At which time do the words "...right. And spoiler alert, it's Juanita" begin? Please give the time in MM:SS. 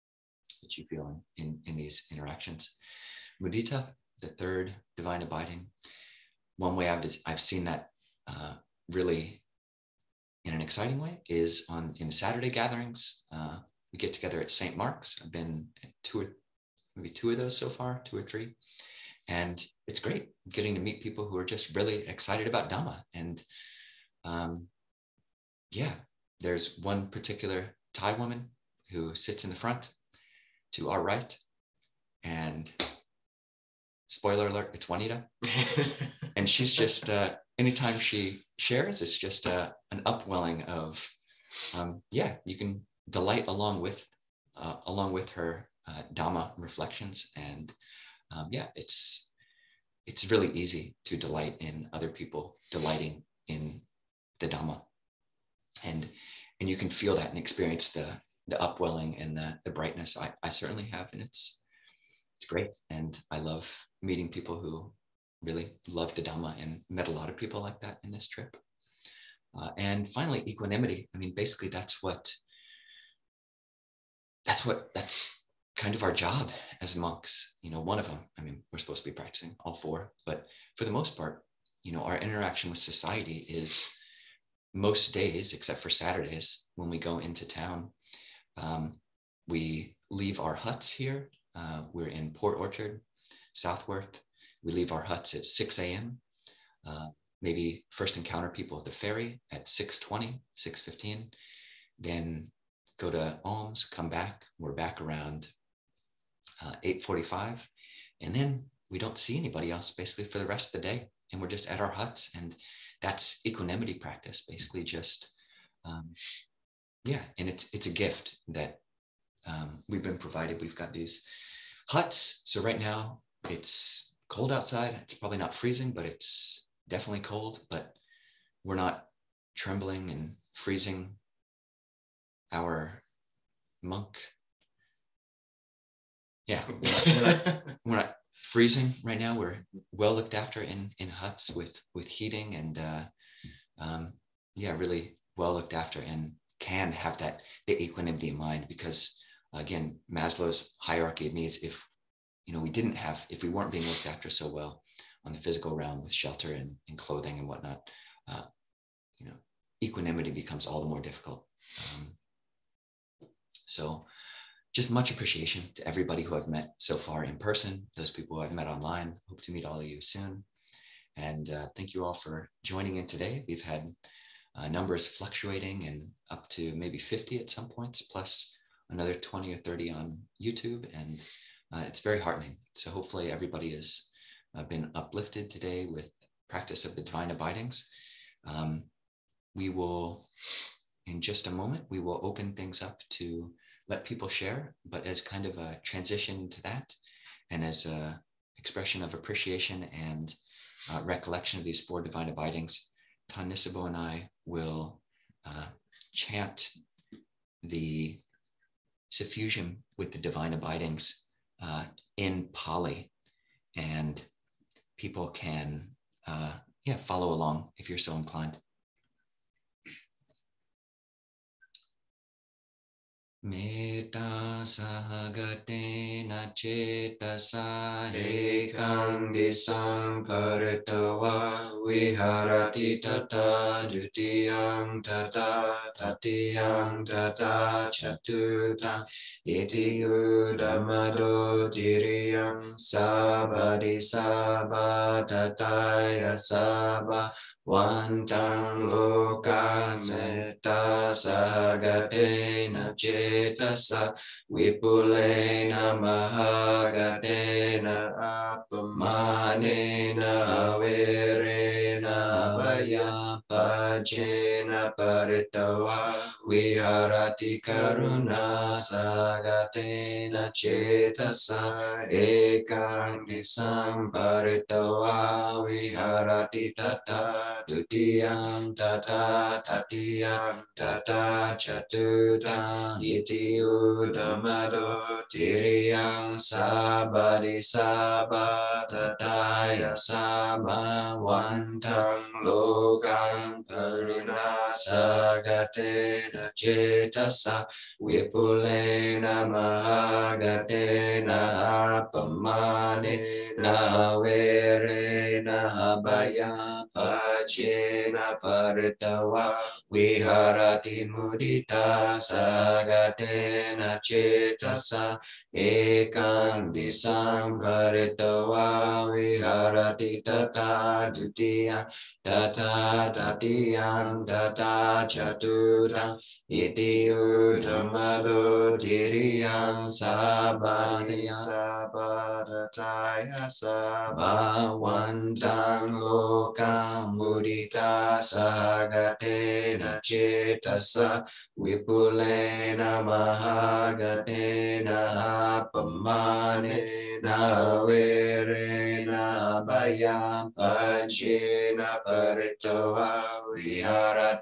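00:31.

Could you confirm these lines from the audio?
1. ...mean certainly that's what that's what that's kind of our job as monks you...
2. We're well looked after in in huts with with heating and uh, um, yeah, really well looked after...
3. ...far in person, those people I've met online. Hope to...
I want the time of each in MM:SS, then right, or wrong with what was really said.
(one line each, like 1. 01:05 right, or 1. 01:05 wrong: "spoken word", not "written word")
1. 01:11 wrong: "basically", not "certainly"
2. 02:19 right
3. 02:46 right.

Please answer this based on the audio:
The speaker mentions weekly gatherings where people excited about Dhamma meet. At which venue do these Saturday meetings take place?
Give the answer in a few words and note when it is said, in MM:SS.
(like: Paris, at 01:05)
St. Mark's, at 00:14.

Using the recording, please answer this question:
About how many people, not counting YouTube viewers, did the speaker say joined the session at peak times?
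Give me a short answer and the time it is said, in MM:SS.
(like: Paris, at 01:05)
50, at 02:56.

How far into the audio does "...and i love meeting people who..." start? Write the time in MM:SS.
01:02.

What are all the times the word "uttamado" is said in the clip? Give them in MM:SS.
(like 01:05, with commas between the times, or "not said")
05:27.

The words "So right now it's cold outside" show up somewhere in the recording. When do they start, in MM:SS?
02:02.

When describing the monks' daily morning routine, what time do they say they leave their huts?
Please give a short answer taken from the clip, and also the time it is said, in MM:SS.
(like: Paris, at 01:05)
6 a.m., at 01:35.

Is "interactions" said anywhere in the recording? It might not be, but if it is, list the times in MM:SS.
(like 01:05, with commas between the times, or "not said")
00:02, 01:22.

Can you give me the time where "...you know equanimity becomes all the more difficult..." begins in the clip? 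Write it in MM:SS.
02:39.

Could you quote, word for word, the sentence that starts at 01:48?
And then we don't see anybody else basically for the rest of the day.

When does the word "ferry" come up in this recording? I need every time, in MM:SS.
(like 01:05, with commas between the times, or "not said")
01:38.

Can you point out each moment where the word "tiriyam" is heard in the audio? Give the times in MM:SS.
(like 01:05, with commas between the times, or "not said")
04:01, 04:45.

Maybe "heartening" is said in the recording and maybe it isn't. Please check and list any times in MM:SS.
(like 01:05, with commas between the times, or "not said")
03:02.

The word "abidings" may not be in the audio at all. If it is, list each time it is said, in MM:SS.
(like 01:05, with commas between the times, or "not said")
00:05, 03:07, 03:22, 03:30.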